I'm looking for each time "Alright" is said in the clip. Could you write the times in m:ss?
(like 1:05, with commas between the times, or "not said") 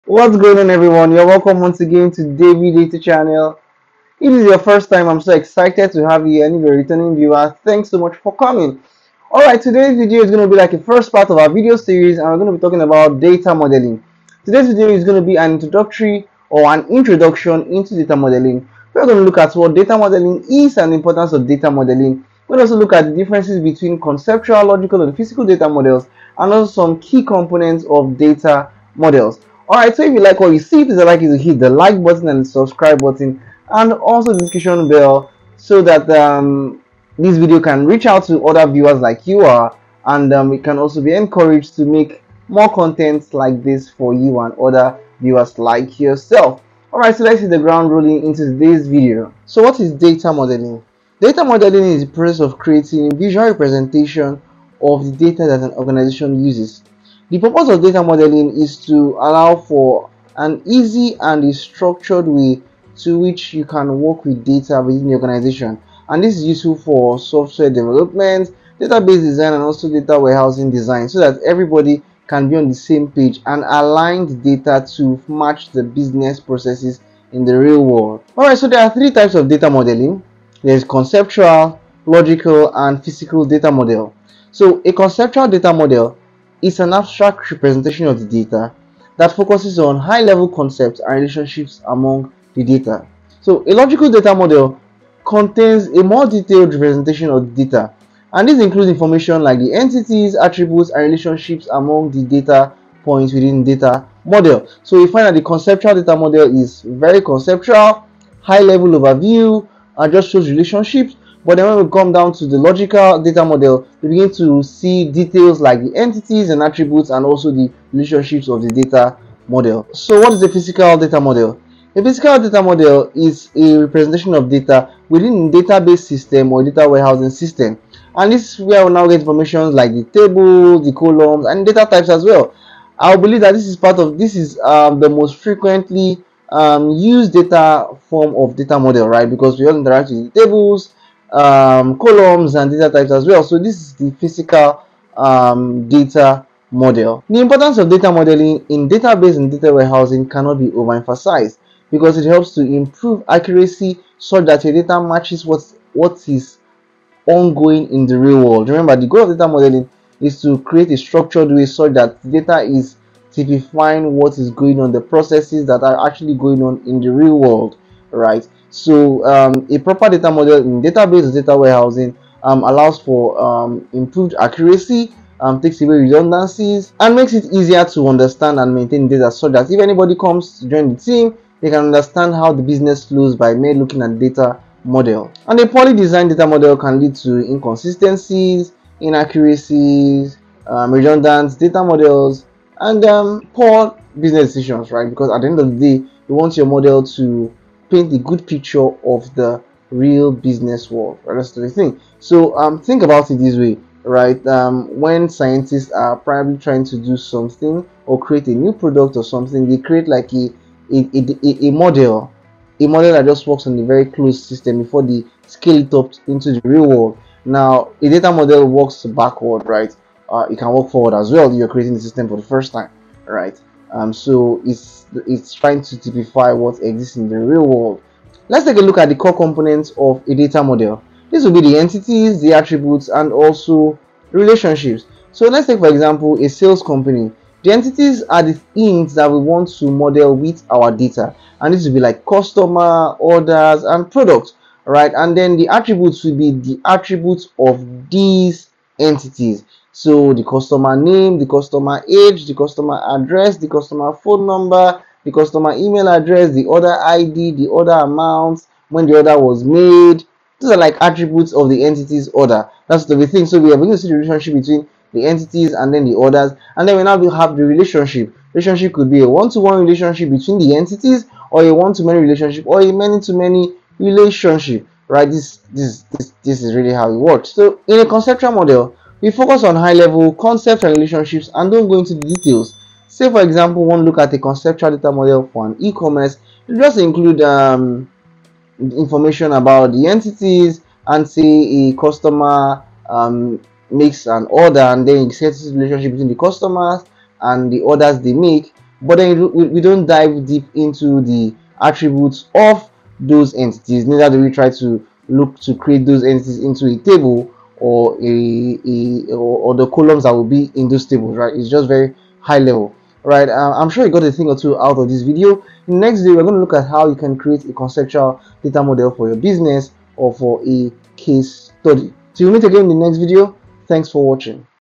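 0:09, 0:29, 0:46, 1:18.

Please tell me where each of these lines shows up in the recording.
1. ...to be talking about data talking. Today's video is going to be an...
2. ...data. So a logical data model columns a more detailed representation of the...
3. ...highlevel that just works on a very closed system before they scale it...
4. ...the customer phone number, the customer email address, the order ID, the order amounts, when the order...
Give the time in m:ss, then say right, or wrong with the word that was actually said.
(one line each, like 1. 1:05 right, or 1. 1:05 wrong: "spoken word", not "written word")
1. 0:12 wrong: "modeling", not "talking"
2. 1:32 wrong: "contains", not "columns"
3. 3:32 wrong: "model", not "highlevel"
4. 4:13 right.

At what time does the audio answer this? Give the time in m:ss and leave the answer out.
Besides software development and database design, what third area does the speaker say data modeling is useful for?
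1:09.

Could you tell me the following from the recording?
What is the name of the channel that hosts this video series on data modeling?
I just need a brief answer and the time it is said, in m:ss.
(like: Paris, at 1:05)
David Data Channel, at 0:02.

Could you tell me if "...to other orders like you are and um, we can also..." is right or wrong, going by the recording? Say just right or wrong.
wrong.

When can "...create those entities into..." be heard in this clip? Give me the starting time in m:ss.
5:05.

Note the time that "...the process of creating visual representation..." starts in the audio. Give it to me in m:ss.
0:52.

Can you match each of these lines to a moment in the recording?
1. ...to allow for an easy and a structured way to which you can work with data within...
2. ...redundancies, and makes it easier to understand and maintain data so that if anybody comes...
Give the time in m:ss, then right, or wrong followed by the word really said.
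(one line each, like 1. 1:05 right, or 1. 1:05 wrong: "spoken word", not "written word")
1. 0:58 right
2. 2:55 right.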